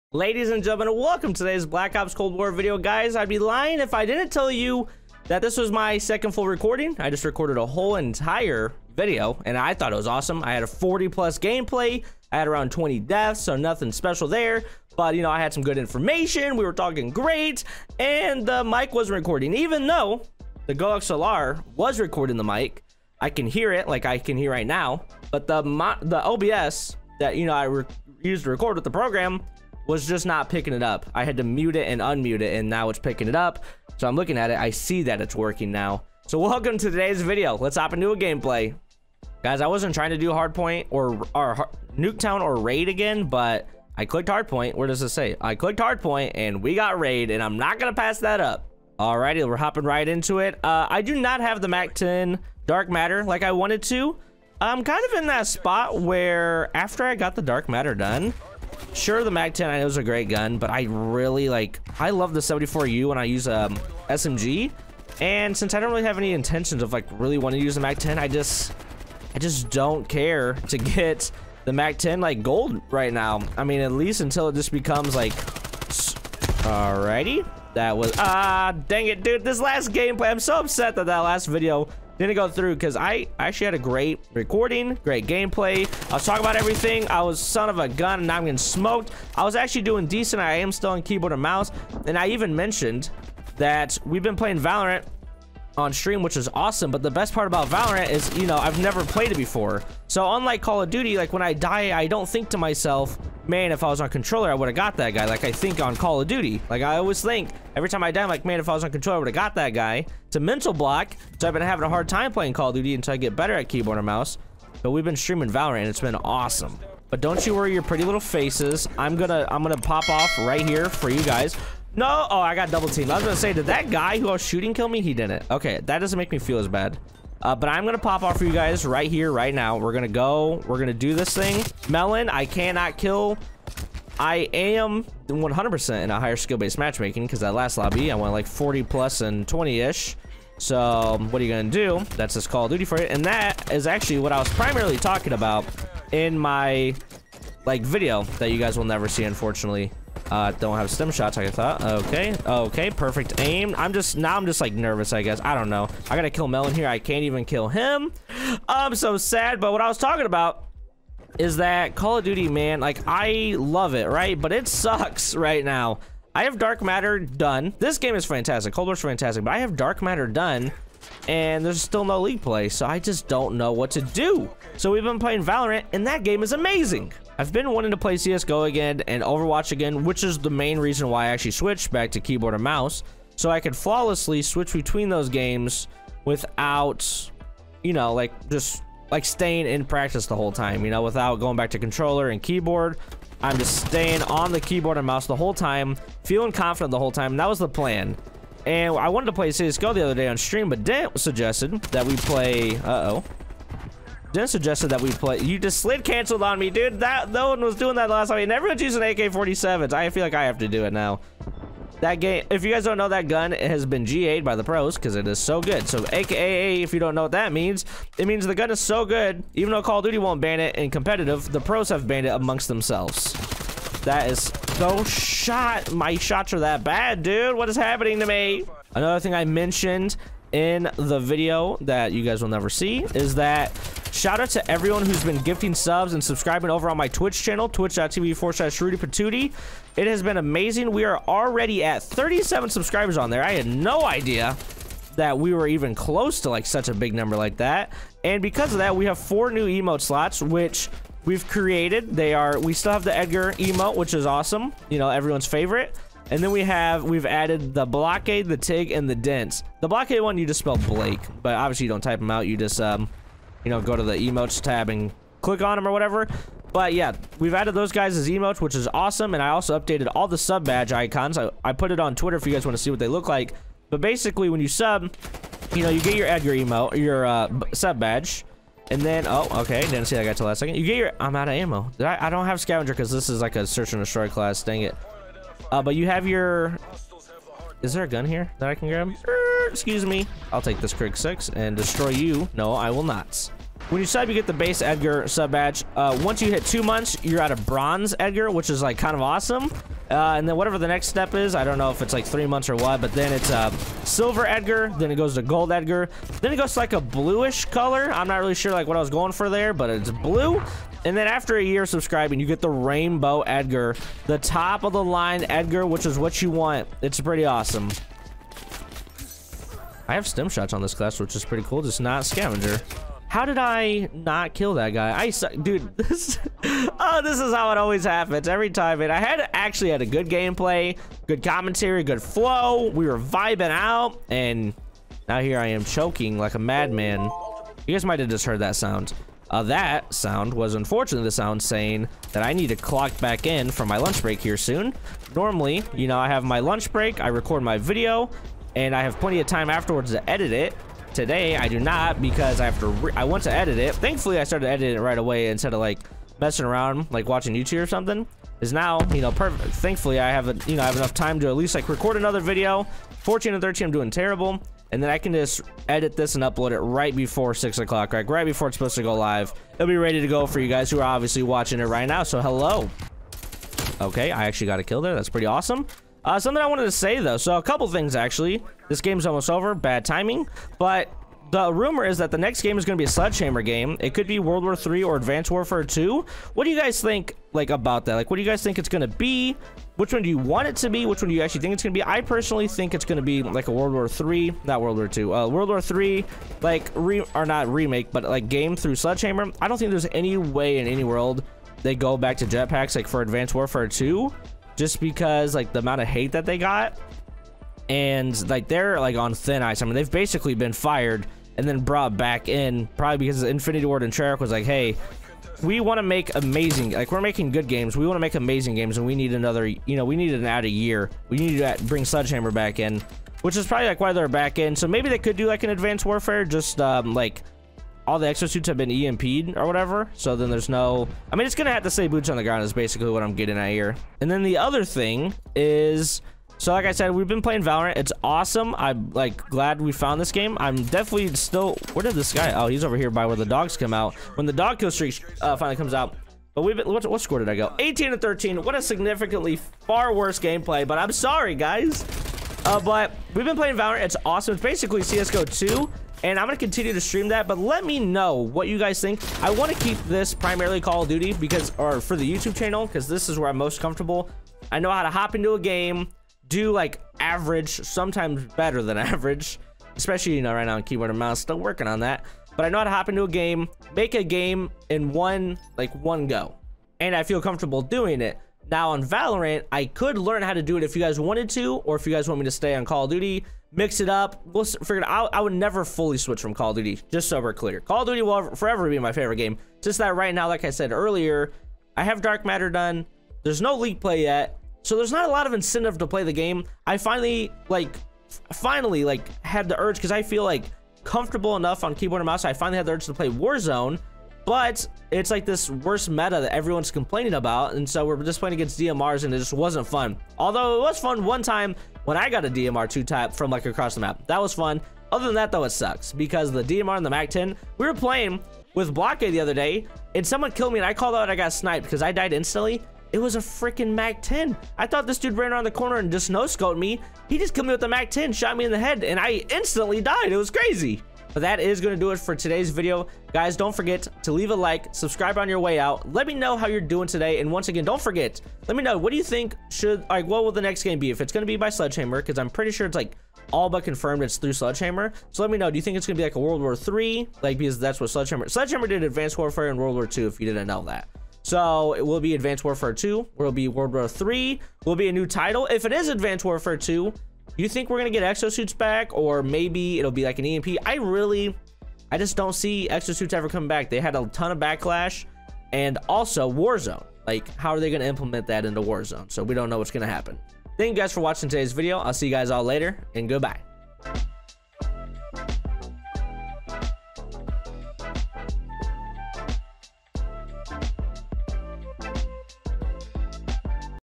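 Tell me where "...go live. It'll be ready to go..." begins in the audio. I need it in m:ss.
6:09.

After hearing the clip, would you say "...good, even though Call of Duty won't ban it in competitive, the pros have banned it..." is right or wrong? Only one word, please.
right.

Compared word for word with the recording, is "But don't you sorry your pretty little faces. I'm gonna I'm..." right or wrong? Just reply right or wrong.
wrong.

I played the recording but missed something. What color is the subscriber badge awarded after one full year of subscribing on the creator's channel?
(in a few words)
rainbow.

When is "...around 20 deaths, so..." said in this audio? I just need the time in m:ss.
0:12.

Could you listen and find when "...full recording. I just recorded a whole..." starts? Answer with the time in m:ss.
0:06.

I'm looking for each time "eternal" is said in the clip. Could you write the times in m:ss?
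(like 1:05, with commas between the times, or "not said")
not said.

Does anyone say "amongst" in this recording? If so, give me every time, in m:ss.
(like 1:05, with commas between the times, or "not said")
3:42.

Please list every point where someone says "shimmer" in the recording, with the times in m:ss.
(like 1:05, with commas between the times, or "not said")
not said.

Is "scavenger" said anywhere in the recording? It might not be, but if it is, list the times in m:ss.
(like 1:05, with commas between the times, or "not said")
4:42, 5:22.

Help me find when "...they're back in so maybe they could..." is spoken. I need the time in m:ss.
7:04.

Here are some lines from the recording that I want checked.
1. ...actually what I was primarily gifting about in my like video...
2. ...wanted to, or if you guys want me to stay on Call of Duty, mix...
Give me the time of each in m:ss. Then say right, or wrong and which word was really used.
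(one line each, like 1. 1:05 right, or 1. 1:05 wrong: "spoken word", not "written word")
1. 2:23 wrong: "talking", not "gifting"
2. 8:01 right.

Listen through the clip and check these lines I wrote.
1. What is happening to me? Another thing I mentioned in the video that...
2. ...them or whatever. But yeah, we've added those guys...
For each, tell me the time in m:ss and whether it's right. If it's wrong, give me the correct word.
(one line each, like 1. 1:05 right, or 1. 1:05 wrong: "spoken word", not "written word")
1. 3:47 right
2. 4:25 right.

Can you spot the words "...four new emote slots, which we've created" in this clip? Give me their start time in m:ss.
4:09.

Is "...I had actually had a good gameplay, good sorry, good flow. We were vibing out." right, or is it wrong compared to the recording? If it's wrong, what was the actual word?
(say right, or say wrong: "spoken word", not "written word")
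wrong: "commentary", not "sorry".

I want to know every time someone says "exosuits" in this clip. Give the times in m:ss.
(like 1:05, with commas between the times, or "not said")
7:08, 9:18, 9:22.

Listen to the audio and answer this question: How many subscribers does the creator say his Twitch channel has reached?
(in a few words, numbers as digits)
37.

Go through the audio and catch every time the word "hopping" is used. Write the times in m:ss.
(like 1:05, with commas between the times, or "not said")
0:49.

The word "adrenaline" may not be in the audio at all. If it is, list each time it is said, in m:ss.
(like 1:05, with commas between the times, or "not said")
not said.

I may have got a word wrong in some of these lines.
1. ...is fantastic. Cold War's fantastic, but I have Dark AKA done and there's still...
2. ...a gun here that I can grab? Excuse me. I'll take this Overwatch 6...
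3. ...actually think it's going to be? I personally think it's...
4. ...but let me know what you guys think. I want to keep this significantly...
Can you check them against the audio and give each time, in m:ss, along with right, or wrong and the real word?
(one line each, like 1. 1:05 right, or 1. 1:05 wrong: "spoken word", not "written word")
1. 2:48 wrong: "Matter", not "AKA"
2. 4:48 wrong: "Krig", not "Overwatch"
3. 6:31 right
4. 7:37 wrong: "primarily", not "significantly".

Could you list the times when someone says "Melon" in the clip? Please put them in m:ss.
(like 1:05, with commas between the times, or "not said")
2:11, 2:36.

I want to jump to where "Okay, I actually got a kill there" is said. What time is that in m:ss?
6:13.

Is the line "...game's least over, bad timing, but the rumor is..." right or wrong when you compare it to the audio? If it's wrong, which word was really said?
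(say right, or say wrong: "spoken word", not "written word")
wrong: "almost", not "least".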